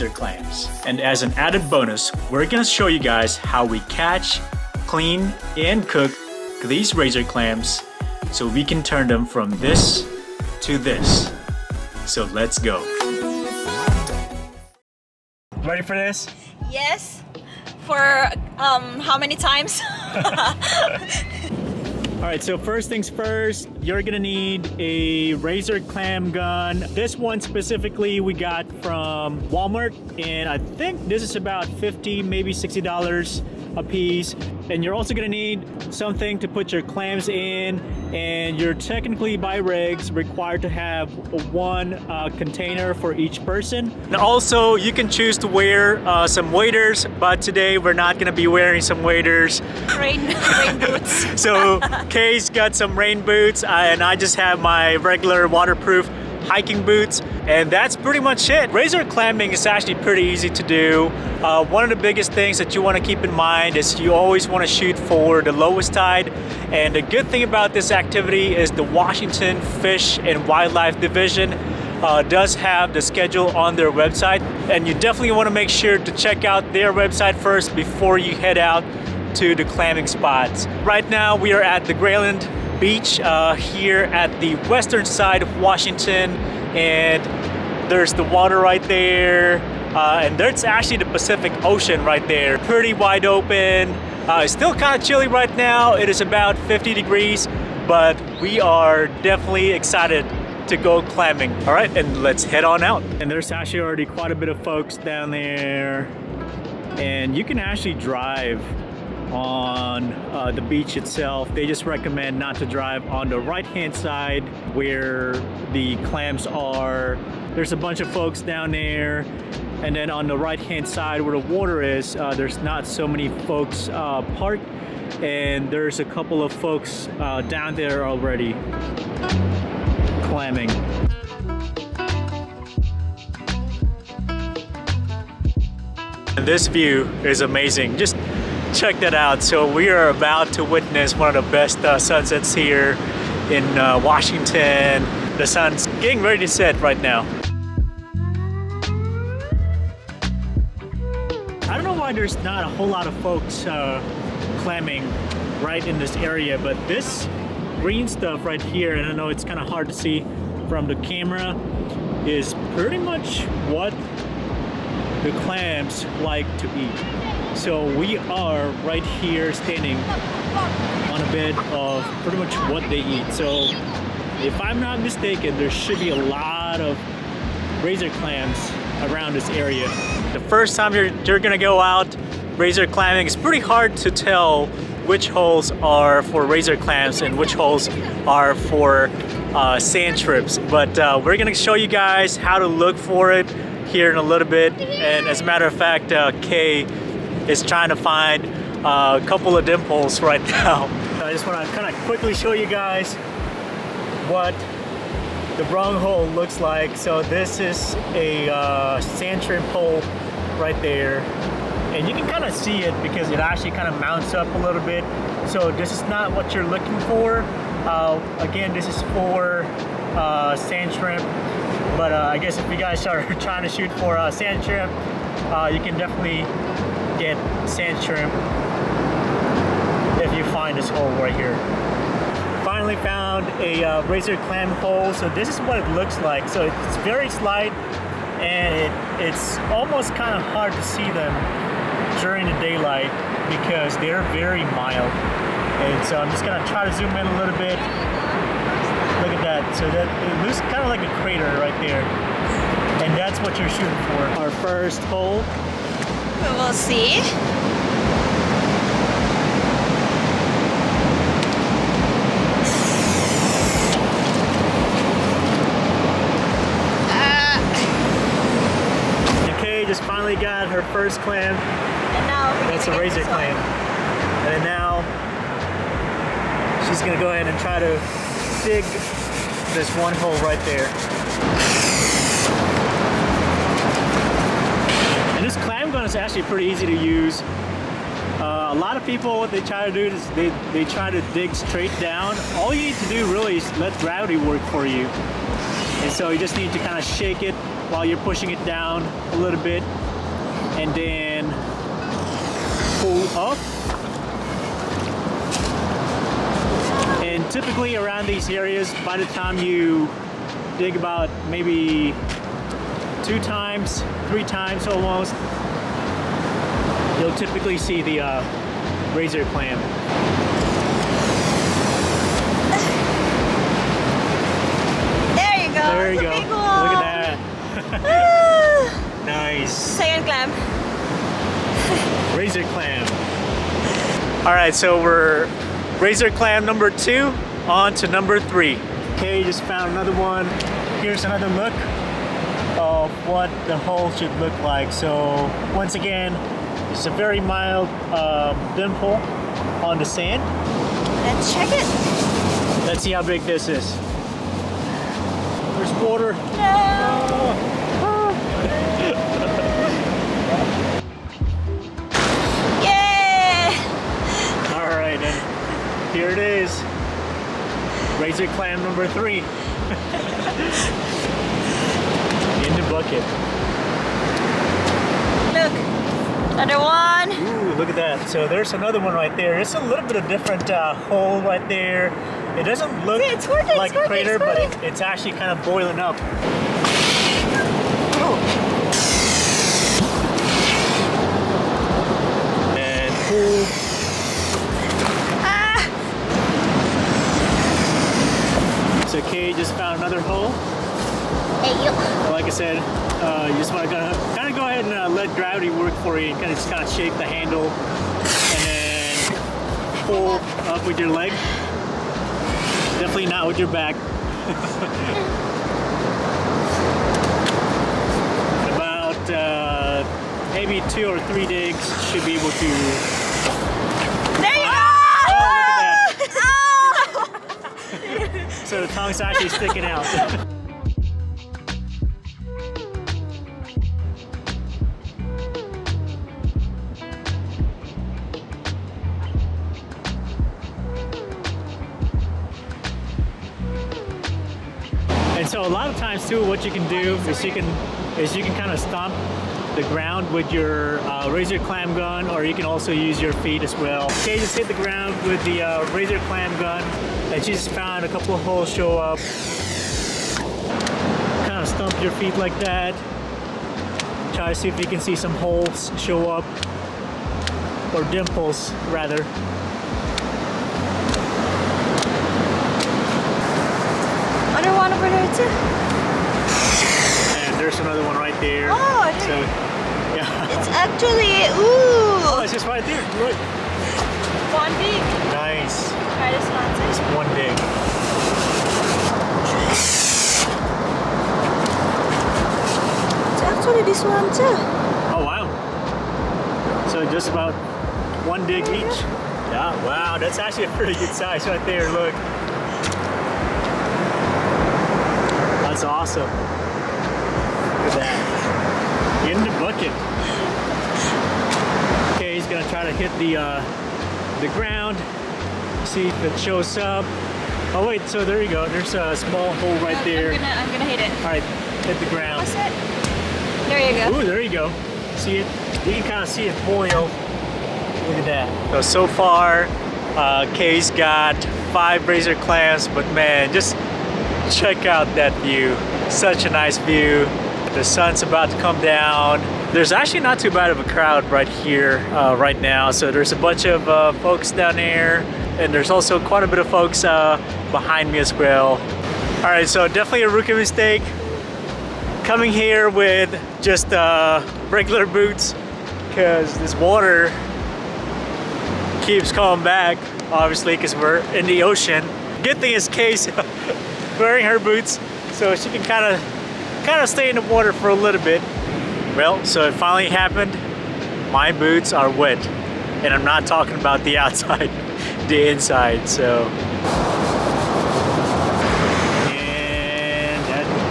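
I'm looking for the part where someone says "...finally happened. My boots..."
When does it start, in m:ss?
9:29.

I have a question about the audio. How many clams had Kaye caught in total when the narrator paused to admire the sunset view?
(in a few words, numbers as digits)
5.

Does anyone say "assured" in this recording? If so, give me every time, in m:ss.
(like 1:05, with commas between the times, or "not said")
not said.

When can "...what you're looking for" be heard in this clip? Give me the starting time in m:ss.
3:36.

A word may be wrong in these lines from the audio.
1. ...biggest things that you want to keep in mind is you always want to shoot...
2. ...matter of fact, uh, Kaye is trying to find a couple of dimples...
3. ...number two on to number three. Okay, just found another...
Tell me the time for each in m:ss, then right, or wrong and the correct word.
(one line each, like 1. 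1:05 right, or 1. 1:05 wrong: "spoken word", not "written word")
1. 1:02 right
2. 3:15 right
3. 5:36 right.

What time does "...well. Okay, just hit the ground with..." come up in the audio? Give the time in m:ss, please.
7:33.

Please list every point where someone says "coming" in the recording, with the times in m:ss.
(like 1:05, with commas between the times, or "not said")
9:12, 9:19.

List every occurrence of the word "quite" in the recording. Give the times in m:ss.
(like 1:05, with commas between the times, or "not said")
1:44, 9:06.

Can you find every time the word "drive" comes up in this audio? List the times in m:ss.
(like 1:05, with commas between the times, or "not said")
1:47, 1:52.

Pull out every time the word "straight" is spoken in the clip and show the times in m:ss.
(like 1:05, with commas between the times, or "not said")
4:51.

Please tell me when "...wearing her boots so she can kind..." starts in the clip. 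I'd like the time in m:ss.
9:24.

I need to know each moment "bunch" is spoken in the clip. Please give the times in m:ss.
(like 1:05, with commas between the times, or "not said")
1:57, 9:03.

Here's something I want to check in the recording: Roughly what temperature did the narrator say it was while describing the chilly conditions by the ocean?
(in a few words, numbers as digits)
50 degrees.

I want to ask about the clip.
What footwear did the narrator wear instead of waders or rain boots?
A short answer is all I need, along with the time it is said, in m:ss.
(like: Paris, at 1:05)
Waterproof hiking boots, at 0:55.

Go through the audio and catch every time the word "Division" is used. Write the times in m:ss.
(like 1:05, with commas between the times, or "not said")
1:11.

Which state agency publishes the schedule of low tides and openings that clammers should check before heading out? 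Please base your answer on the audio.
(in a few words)
Washington Fish and Wildlife.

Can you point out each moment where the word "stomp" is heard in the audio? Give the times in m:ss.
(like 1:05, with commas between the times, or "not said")
7:28, 7:41.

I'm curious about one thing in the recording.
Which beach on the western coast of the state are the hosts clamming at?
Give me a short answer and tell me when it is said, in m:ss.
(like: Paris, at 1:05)
Grayland beach, at 1:21.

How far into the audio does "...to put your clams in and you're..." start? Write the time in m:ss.
0:36.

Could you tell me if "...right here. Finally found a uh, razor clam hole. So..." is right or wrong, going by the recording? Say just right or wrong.
right.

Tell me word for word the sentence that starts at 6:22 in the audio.
It doesn't look it's working, like it's crater, but it, it's actually kind of boiling up.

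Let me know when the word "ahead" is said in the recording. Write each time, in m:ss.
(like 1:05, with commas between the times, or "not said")
4:37, 6:44.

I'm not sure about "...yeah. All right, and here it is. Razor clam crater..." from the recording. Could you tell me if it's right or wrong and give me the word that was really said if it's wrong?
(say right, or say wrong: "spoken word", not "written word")
wrong: "number", not "crater".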